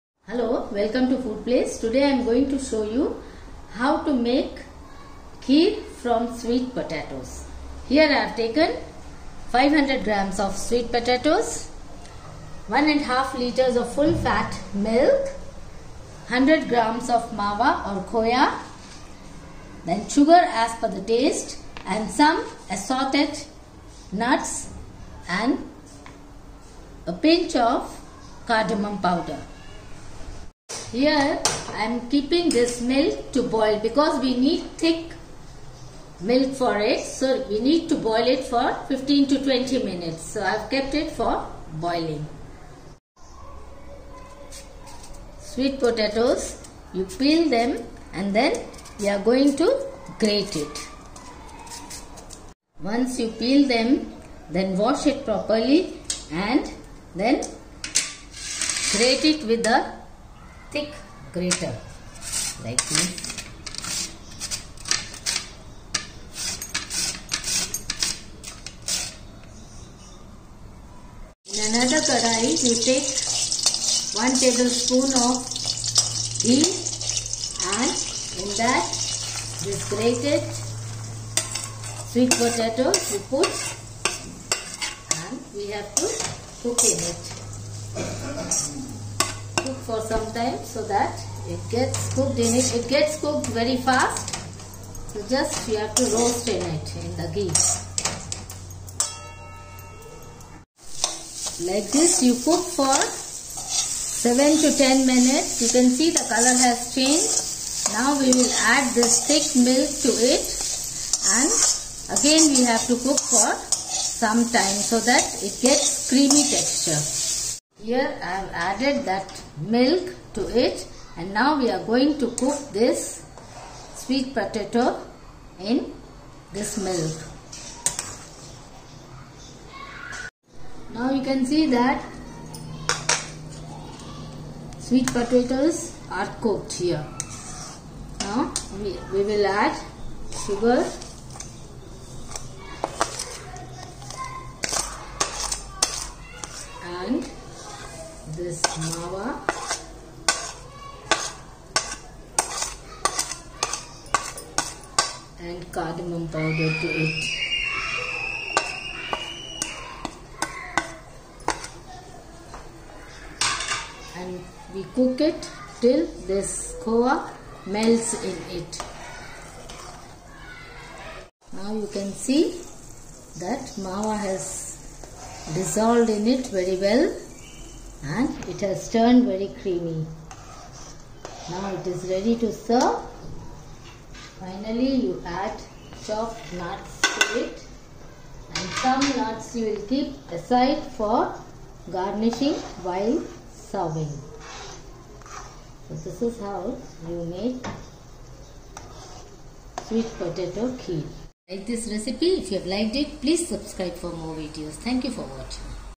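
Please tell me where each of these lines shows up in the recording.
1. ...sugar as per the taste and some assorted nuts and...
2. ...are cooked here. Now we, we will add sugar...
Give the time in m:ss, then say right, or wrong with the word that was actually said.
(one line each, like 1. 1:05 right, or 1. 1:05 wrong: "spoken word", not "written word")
1. 0:20 right
2. 2:16 right.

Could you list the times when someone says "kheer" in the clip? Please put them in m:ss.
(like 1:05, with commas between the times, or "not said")
0:05, 3:20.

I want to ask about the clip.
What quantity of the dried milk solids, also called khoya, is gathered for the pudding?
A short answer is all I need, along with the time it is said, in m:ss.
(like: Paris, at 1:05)
100 grams, at 0:16.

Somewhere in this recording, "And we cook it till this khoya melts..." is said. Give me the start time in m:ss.
2:44.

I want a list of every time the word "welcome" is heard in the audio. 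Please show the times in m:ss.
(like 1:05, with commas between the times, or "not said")
0:00.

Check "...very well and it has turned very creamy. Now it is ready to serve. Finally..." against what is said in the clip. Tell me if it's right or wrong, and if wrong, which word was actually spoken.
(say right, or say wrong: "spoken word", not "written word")
right.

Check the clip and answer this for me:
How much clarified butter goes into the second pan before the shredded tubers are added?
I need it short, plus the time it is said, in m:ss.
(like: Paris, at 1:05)
1 tablespoon, at 1:14.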